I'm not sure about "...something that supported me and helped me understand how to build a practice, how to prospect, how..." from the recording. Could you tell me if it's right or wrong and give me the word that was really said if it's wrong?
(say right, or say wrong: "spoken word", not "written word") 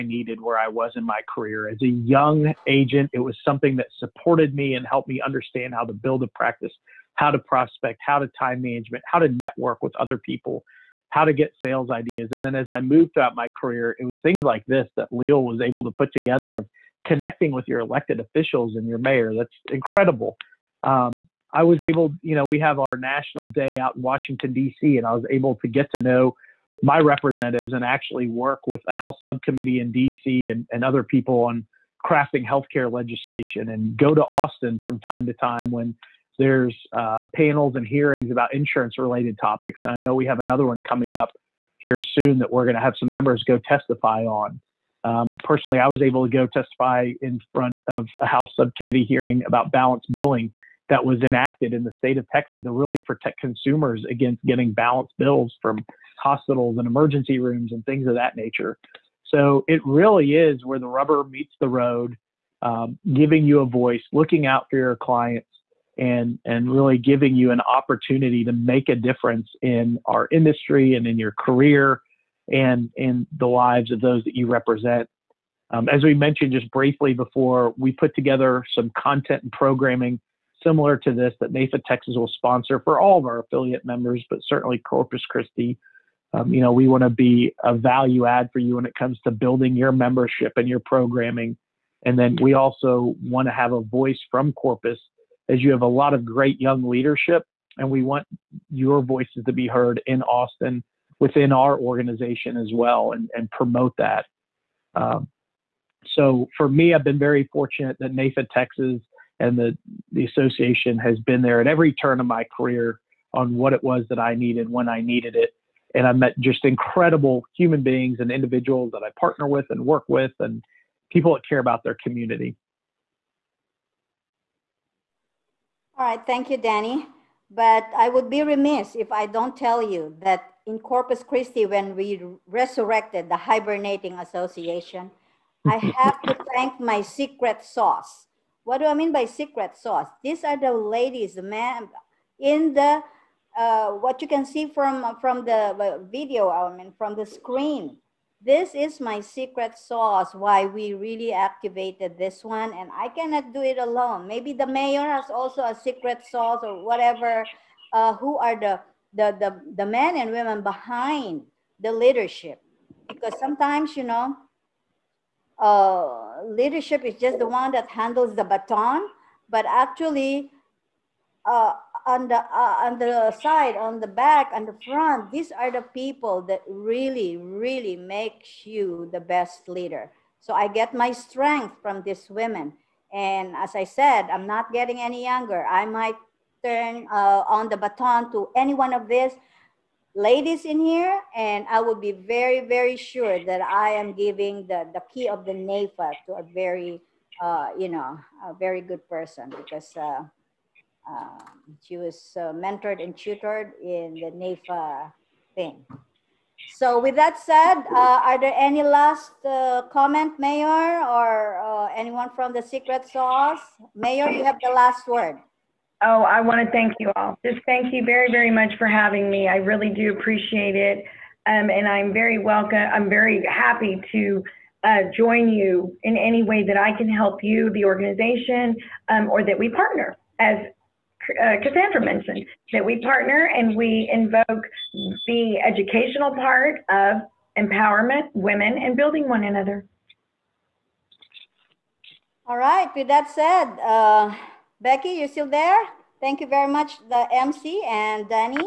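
right.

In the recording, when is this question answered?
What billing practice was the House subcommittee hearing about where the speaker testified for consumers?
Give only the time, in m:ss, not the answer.
0:49.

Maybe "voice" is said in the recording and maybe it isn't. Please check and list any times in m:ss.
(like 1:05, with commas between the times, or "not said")
1:03, 1:33, 1:39.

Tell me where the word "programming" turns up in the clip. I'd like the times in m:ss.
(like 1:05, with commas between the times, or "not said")
1:19, 1:30.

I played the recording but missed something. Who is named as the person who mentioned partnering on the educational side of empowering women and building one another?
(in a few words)
Cassandra.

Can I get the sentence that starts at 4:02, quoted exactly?
All right, with that said, uh, Becky, you're still there?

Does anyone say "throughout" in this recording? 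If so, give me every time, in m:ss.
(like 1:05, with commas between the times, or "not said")
0:13.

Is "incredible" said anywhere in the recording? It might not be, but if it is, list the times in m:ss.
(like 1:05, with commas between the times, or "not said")
0:19, 1:56.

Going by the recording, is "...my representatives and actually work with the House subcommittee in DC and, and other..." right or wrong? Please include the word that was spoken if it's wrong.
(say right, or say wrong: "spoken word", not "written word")
right.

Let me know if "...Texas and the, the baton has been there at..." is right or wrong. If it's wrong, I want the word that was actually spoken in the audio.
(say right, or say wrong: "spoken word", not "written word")
wrong: "association", not "baton".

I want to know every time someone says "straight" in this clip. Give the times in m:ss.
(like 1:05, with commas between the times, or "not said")
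not said.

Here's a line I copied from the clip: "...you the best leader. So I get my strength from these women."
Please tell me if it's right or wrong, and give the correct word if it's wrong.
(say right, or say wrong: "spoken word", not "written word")
right.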